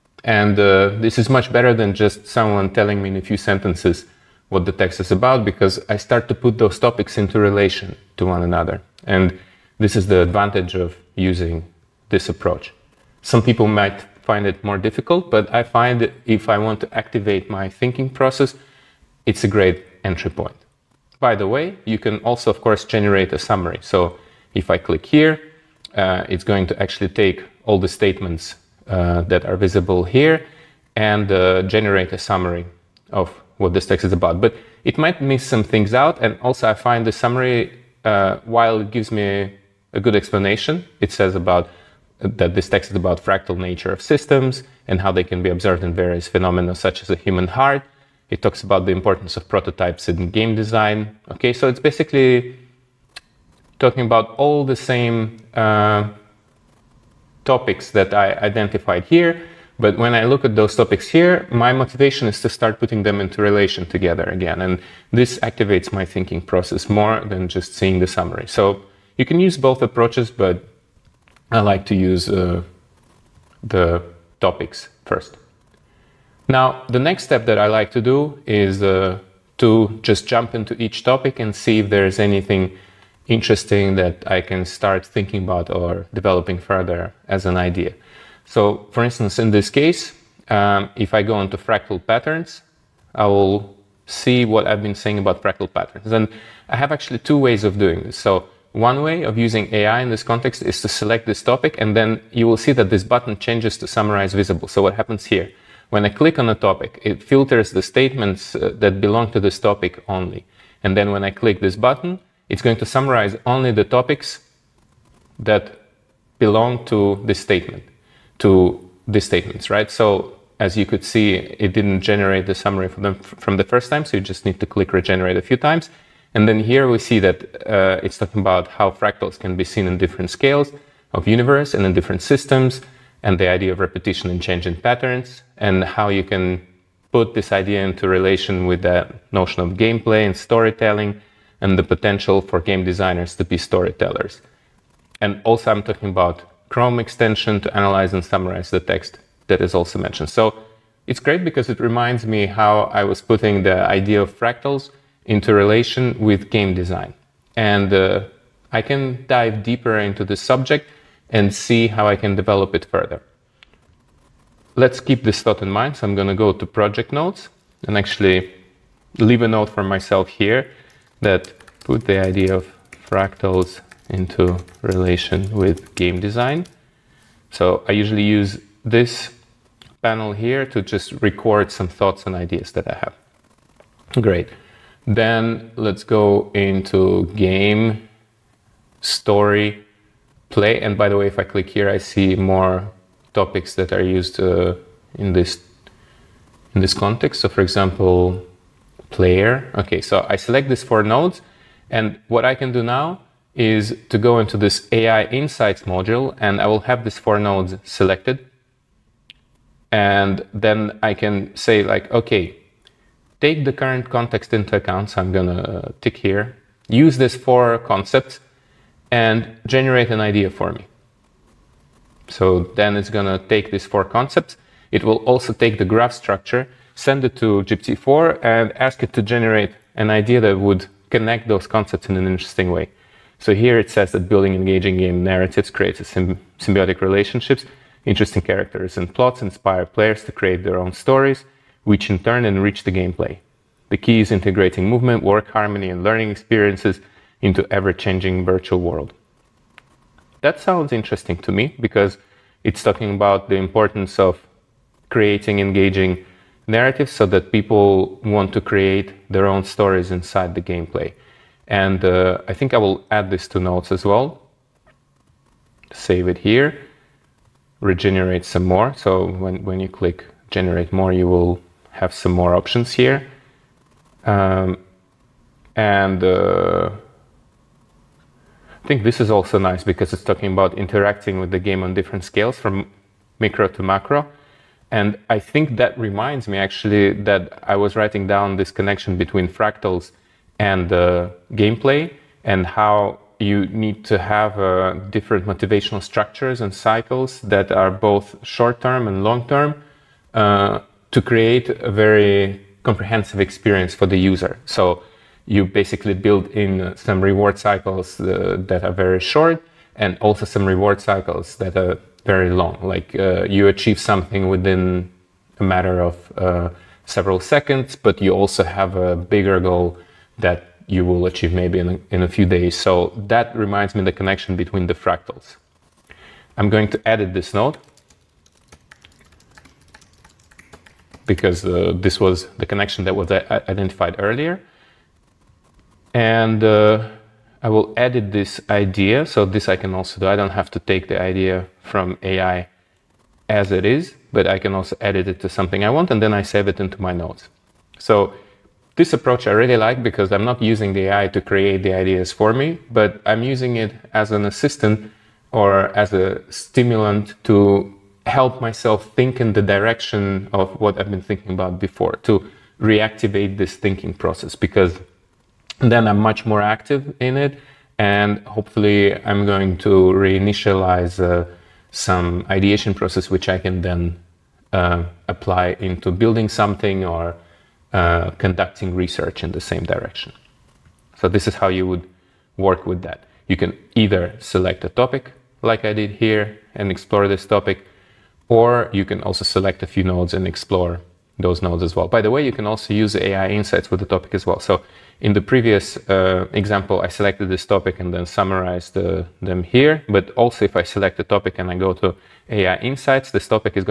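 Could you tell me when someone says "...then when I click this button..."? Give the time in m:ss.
1:50.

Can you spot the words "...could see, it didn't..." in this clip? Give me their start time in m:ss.
2:00.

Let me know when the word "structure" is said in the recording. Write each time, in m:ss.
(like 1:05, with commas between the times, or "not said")
3:46, 4:56.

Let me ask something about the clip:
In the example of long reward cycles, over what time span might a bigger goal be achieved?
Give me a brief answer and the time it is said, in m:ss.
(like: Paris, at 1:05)
a few days, at 5:22.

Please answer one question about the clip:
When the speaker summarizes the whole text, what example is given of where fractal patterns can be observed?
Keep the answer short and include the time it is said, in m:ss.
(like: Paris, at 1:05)
the human heart, at 0:47.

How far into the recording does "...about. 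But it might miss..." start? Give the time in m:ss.
0:34.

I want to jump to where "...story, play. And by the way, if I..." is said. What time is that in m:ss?
3:09.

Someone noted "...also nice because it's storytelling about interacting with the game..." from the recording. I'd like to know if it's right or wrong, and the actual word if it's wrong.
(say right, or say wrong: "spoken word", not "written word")
wrong: "talking", not "storytelling".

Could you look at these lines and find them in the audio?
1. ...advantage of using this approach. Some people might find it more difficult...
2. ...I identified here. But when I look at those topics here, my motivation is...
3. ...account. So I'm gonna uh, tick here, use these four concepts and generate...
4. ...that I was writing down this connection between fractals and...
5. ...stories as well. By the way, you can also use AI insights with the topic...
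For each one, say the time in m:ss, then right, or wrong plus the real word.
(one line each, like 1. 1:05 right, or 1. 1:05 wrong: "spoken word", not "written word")
1. 0:10 right
2. 0:58 right
3. 3:34 right
4. 4:47 right
5. 6:31 wrong: "nodes", not "stories".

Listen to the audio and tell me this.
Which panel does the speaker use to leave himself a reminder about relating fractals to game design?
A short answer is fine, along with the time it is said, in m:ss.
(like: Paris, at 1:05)
project notes, at 2:46.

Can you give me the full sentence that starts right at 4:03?
The key is integrating movement, work harmony, and learning experiences into ever-changing virtual world.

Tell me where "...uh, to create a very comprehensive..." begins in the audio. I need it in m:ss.
5:00.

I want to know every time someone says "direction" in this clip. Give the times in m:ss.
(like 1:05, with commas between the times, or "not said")
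5:59, 6:19.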